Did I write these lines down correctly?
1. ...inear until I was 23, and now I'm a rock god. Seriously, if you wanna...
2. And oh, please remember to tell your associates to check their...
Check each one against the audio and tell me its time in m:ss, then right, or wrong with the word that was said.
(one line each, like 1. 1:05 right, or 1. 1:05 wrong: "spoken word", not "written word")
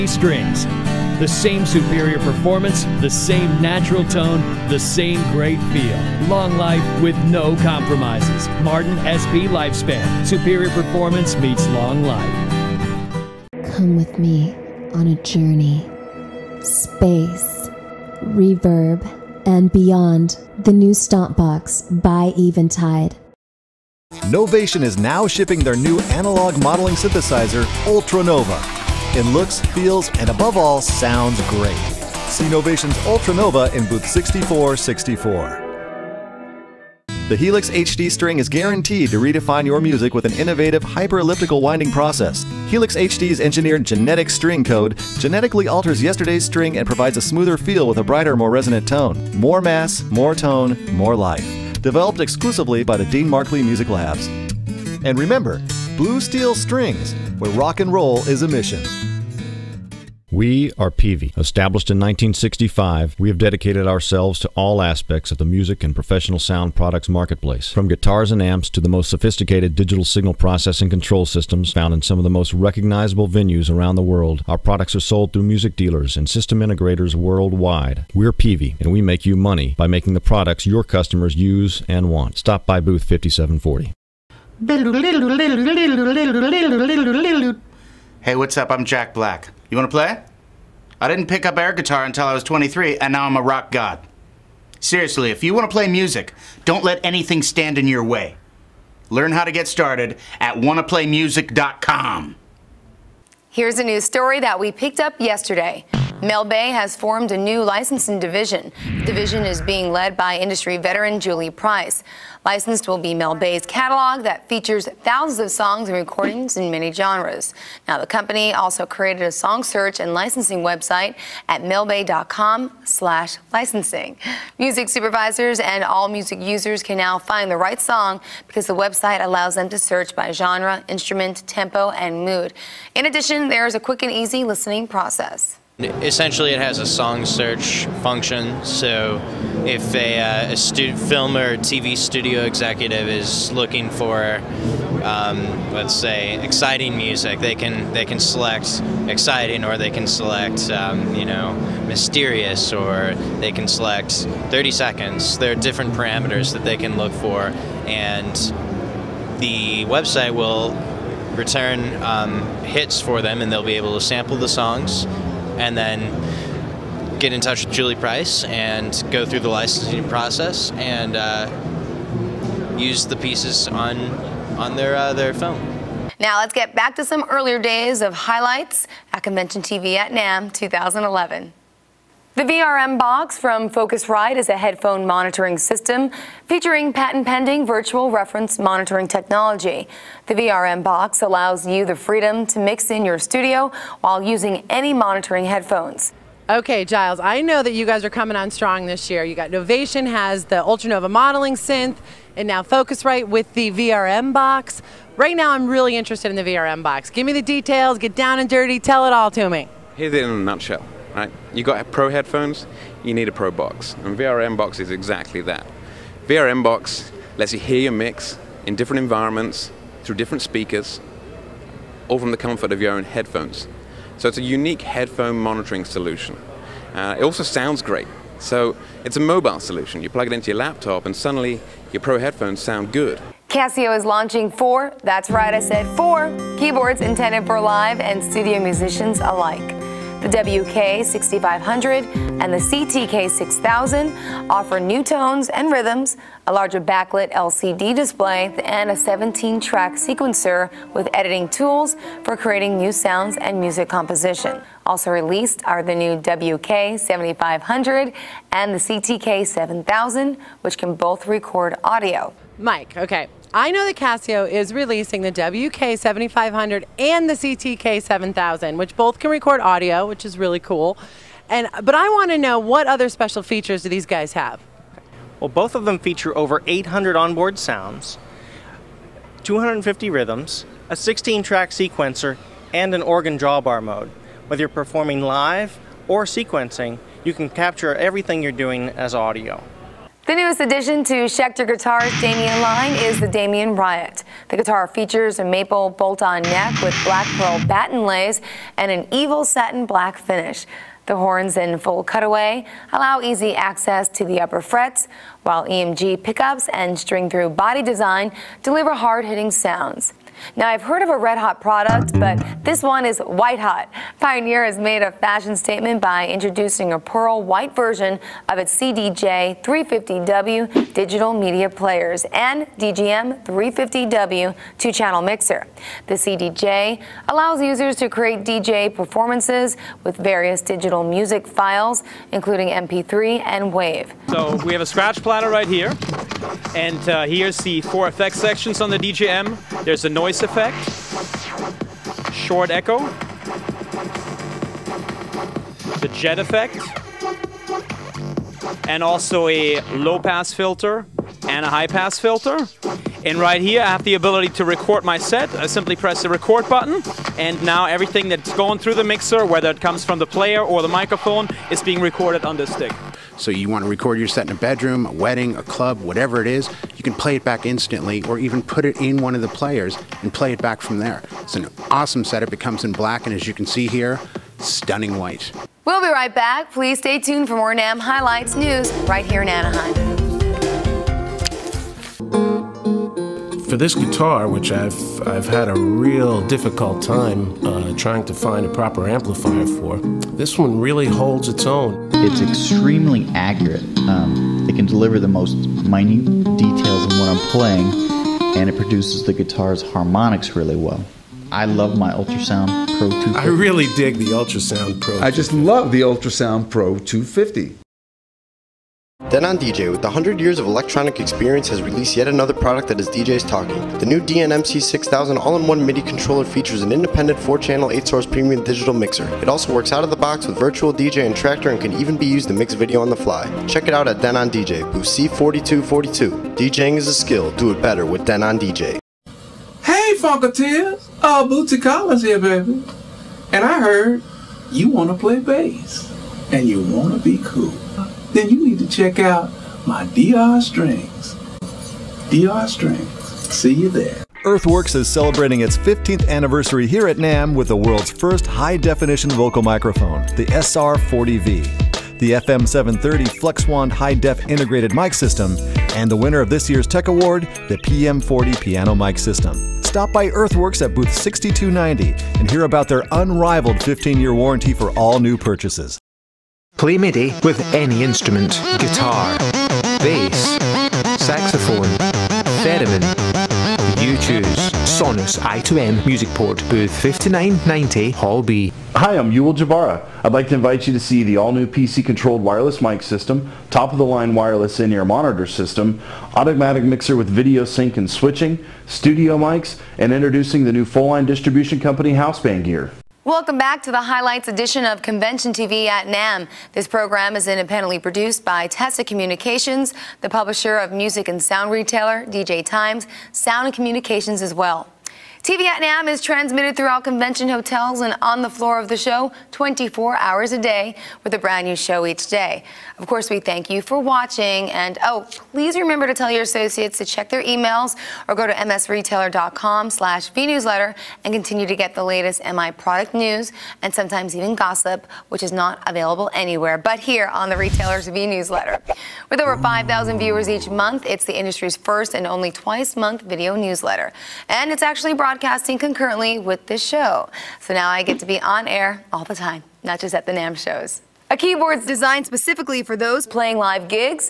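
1. 1:31 wrong: "guitar", not "inear"
2. 8:34 right.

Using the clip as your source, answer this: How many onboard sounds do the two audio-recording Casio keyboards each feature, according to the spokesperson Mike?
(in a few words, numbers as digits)
over 800.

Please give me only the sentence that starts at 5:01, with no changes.
The horns in full cutaway allow easy access to the upper frets, while EMG pickups and string-through body design deliver hard-hitting sounds.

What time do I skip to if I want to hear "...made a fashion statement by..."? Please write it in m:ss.
5:14.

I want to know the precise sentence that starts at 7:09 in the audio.
Hey Funketeers, uh, Bootsy Collins here baby.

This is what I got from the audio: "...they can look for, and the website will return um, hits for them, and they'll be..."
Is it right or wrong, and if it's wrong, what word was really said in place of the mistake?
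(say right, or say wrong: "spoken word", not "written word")
right.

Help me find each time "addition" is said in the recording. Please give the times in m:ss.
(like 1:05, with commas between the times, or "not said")
2:13, 4:50.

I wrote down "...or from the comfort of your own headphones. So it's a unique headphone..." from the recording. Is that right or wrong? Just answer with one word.
right.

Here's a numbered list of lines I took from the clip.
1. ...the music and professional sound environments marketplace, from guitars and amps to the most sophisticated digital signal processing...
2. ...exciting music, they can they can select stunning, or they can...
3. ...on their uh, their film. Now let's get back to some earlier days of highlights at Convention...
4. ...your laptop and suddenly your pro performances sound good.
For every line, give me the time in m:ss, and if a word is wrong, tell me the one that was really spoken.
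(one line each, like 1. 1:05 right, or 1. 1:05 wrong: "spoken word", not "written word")
1. 1:05 wrong: "products", not "environments"
2. 2:26 wrong: "exciting", not "stunning"
3. 2:54 right
4. 3:50 wrong: "headphones", not "performances".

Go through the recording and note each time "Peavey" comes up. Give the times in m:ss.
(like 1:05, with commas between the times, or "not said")
1:00, 1:18.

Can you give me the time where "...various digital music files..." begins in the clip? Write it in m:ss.
5:30.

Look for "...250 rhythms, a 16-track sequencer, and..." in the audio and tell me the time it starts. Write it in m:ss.
4:39.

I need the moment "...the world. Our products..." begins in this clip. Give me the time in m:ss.
1:13.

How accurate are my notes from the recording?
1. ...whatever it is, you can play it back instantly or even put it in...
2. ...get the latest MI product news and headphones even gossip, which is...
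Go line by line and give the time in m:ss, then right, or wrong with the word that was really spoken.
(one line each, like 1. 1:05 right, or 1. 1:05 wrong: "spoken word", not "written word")
1. 6:06 right
2. 8:41 wrong: "sometimes", not "headphones".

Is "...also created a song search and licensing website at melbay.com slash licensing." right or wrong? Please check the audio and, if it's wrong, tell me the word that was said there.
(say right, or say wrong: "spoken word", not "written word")
right.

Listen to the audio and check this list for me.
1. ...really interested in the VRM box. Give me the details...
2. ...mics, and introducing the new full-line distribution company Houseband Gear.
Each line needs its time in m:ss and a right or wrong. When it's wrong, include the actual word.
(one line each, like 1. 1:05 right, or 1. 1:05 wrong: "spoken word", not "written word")
1. 3:25 right
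2. 8:09 right.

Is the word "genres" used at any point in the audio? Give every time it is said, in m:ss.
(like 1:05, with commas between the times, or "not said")
1:56, 2:10.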